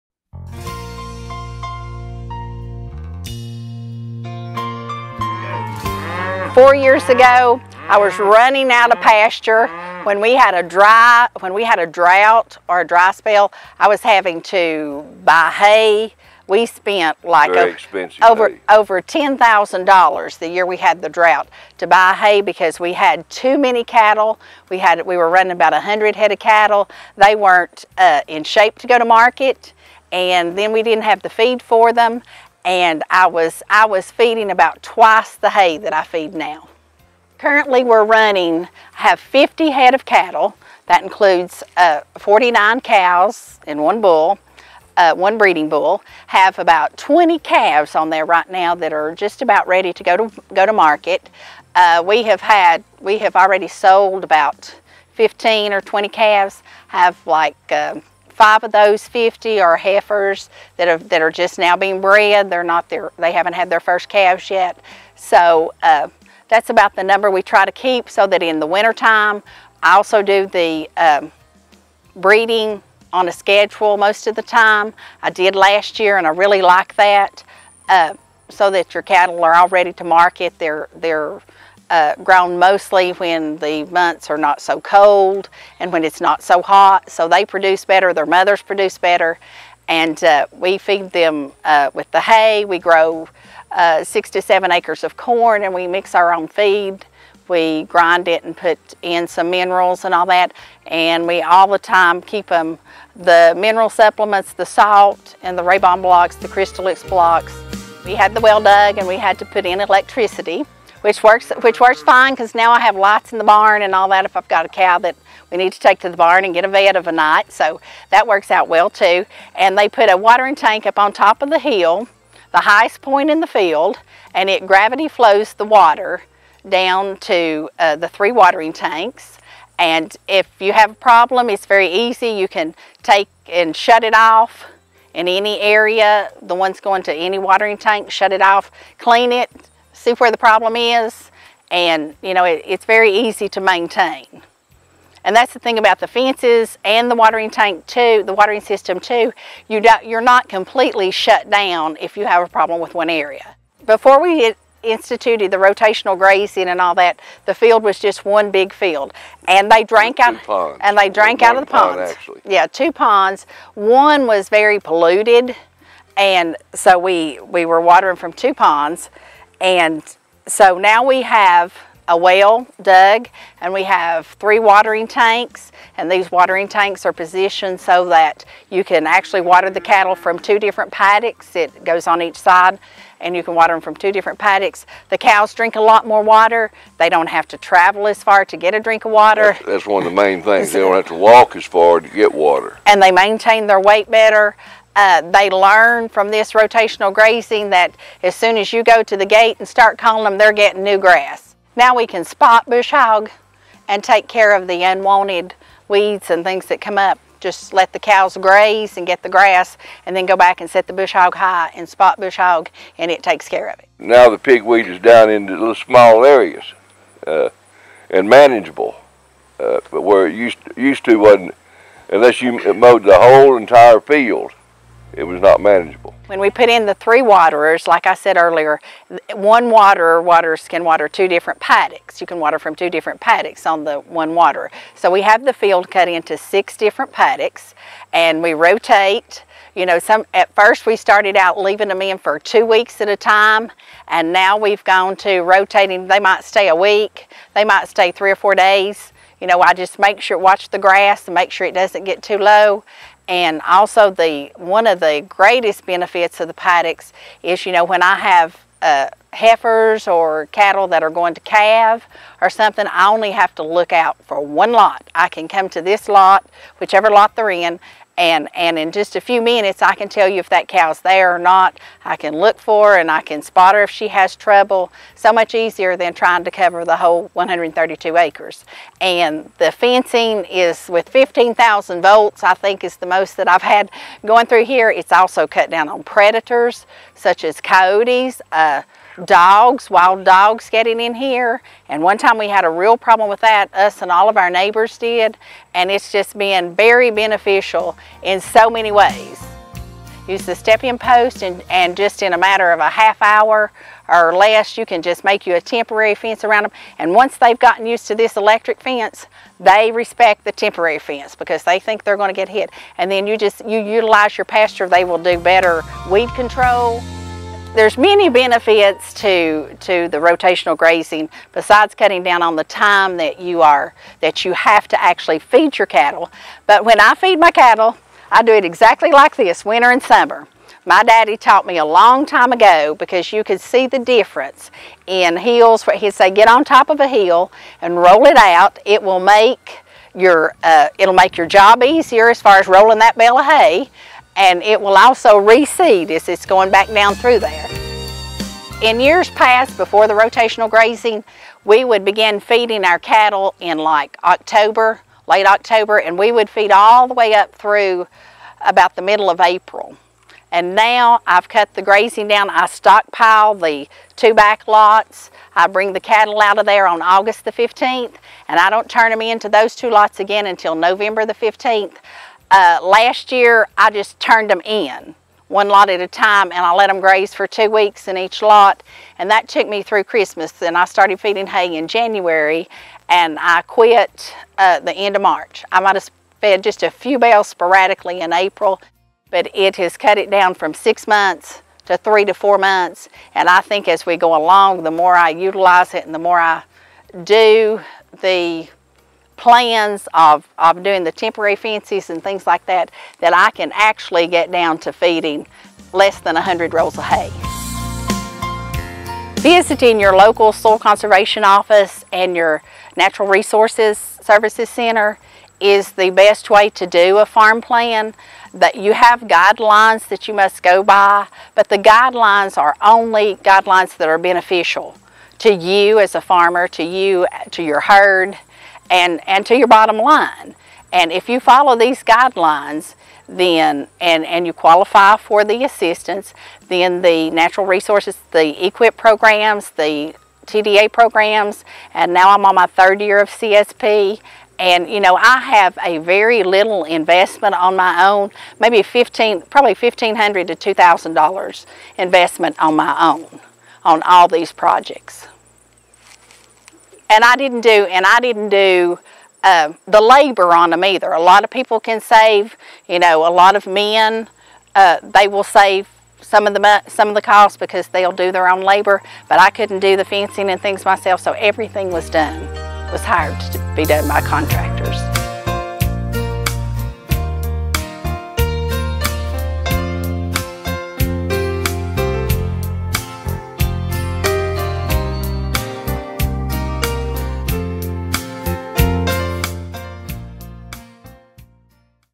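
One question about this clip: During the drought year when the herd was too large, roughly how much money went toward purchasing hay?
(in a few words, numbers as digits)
over $10,000.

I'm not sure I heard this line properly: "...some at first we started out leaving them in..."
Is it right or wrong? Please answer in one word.
right.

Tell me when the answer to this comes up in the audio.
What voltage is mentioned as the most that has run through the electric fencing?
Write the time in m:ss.
4:41.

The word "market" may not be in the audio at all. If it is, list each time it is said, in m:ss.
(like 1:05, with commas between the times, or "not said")
0:29, 0:50, 1:20.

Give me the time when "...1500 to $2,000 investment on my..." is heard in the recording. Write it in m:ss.
7:29.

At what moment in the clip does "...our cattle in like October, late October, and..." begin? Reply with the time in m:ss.
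5:52.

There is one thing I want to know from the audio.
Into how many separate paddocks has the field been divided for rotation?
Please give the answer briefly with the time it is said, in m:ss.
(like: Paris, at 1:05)
6, at 3:56.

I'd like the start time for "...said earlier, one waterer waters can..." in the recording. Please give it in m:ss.
3:48.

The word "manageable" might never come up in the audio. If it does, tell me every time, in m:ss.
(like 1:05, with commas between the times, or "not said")
3:38, 3:45.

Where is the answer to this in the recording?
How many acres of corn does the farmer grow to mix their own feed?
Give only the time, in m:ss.
1:34.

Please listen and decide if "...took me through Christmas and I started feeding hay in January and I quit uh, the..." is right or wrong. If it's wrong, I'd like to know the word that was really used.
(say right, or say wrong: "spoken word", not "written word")
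right.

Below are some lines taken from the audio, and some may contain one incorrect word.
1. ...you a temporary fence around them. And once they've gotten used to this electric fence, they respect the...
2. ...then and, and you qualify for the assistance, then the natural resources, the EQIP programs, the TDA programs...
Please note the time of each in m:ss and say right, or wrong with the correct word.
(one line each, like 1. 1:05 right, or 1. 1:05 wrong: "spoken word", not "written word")
1. 5:05 right
2. 7:13 right.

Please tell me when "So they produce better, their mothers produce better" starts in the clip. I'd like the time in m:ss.
1:27.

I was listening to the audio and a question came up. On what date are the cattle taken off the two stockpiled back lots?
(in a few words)
August 15.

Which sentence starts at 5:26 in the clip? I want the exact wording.
But when I feed my cattle, I do it exactly like this, winter and summer.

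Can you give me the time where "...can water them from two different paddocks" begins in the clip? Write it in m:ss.
3:03.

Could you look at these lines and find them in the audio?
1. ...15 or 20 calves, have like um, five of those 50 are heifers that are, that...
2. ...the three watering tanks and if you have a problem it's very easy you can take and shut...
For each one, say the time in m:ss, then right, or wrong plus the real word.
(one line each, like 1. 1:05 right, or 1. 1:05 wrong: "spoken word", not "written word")
1. 0:55 right
2. 2:07 right.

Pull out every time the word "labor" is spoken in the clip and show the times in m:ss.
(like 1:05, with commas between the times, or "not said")
7:39, 7:48.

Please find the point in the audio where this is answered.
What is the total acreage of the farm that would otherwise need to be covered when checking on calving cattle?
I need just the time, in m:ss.
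4:37.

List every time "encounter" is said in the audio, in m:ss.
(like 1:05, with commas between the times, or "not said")
not said.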